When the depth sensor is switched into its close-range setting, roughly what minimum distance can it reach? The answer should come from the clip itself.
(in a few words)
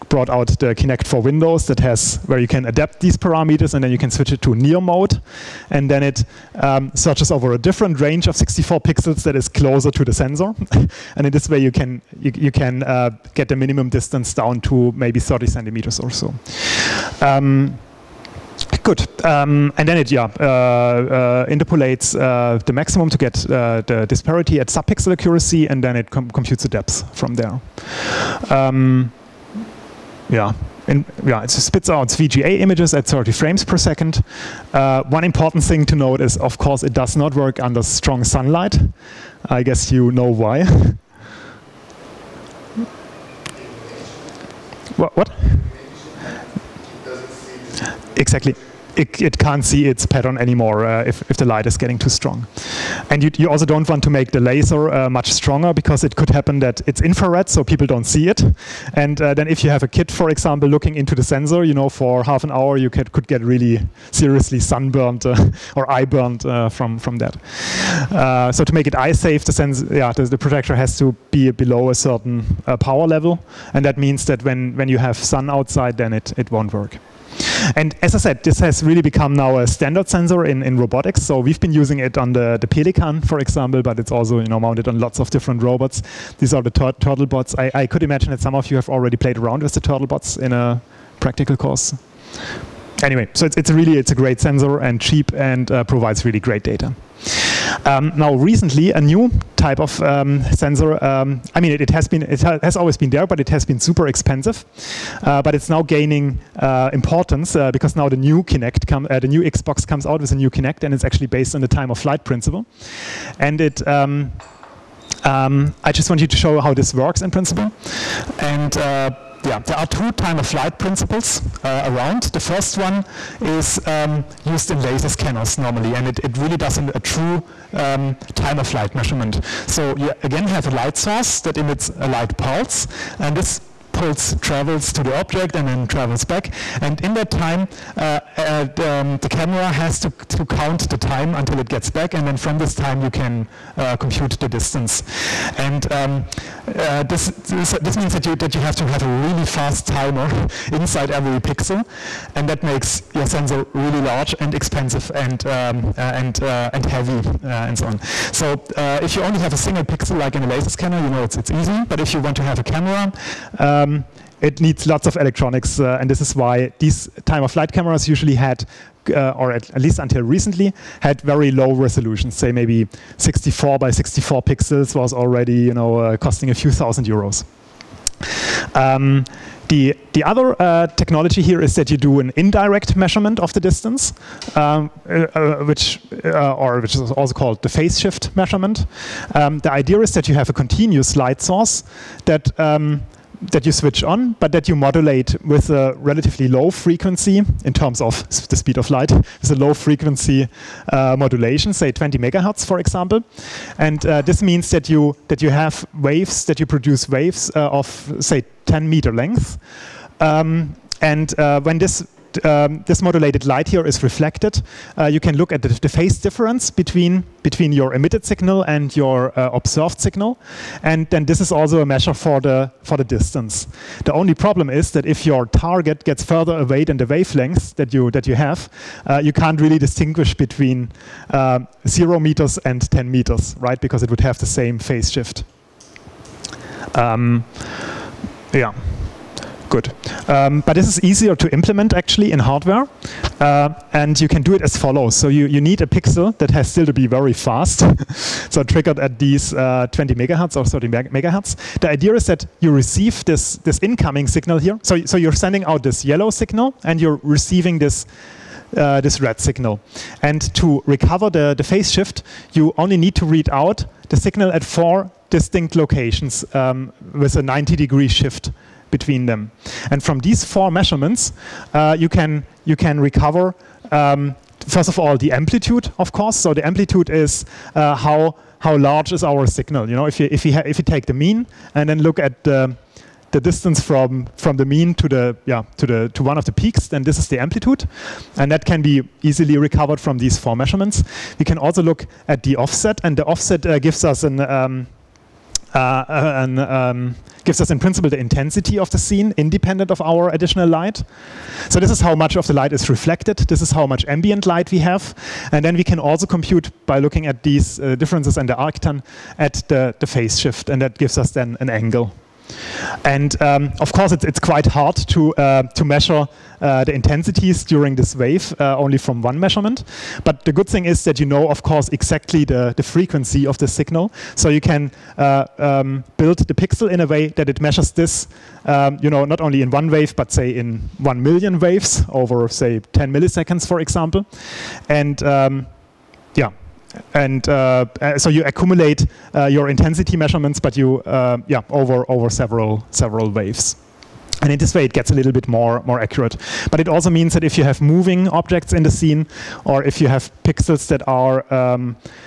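30 centimeters.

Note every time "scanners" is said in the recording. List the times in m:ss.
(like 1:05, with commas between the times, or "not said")
2:05, 2:40.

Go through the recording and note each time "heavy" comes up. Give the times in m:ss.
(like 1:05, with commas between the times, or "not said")
2:36.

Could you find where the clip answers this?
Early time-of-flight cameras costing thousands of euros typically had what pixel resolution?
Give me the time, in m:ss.
2:53.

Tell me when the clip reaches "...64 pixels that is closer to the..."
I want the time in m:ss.
0:08.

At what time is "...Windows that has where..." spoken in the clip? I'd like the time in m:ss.
0:01.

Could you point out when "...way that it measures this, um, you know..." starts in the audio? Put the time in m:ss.
5:27.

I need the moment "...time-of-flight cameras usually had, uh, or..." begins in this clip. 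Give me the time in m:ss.
2:47.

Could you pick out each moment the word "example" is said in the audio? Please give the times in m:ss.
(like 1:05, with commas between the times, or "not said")
1:00, 1:23, 3:22, 5:33.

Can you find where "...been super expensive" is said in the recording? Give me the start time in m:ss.
1:43.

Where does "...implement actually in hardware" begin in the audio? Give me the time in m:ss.
4:01.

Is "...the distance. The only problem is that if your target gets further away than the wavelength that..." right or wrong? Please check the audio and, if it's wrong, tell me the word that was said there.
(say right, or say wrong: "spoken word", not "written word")
right.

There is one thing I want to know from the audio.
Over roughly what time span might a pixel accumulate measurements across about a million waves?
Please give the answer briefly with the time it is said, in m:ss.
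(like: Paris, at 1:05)
10 milliseconds, at 5:32.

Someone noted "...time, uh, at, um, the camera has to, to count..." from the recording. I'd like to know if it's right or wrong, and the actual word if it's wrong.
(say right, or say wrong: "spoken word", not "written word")
right.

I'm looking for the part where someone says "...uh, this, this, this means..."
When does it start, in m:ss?
2:26.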